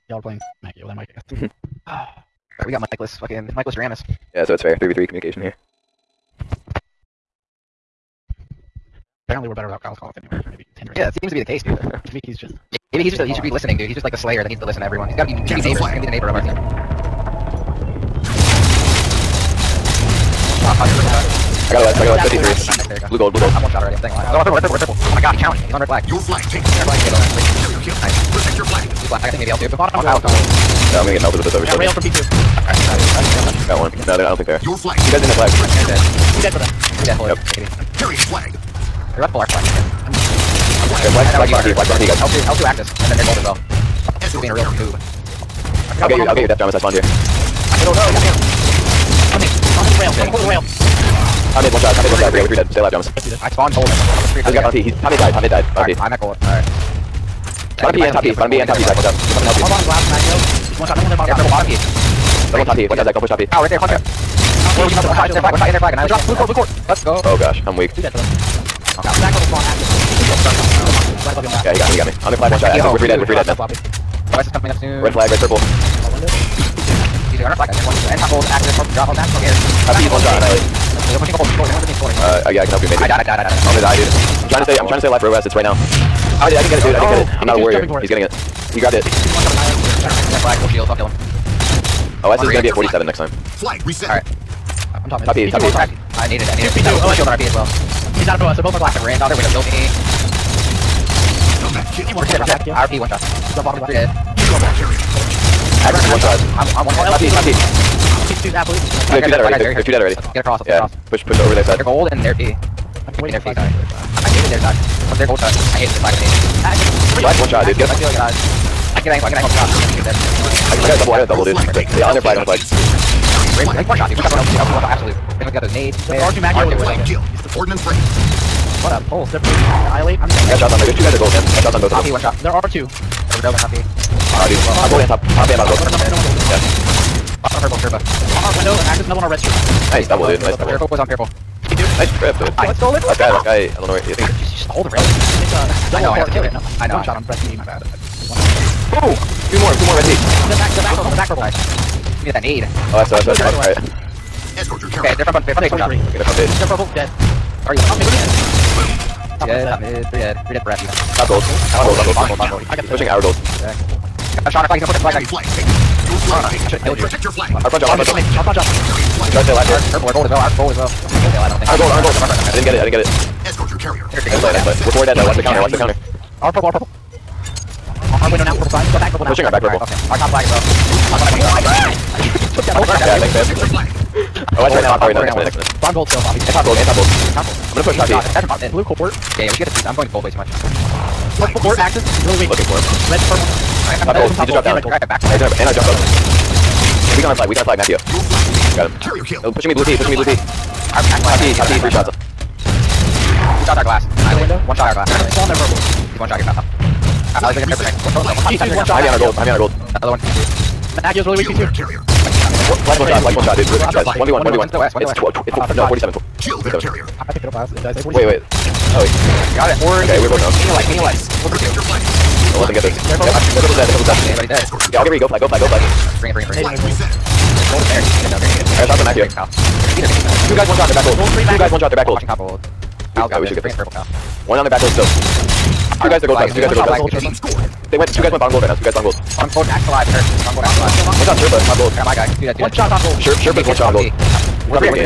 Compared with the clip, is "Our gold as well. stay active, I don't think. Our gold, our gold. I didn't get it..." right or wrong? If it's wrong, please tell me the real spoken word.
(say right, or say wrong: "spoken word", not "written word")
wrong: "alive", not "active".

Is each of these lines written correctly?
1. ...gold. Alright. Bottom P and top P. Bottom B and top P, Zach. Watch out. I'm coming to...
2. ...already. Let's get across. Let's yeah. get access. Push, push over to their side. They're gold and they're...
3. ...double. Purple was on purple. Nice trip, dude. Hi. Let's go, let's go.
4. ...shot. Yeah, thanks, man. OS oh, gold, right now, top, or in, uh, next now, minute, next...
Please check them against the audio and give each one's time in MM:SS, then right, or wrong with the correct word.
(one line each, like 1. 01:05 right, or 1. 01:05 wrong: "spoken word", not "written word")
1. 00:56 right
2. 01:49 wrong: "across", not "access"
3. 02:20 right
4. 03:02 right.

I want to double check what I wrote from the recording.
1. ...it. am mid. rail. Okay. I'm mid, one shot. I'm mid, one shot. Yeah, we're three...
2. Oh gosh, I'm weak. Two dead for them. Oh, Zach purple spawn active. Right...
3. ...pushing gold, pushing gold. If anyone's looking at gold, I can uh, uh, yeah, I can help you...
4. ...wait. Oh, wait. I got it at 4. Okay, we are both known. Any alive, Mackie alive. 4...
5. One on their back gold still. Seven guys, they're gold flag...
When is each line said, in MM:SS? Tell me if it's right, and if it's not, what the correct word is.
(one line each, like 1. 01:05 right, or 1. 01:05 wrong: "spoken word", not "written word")
1. 00:50 right
2. 01:07 right
3. 01:21 right
4. 03:38 wrong: "Any", not "Mackie"
5. 03:54 wrong: "Two", not "Seven".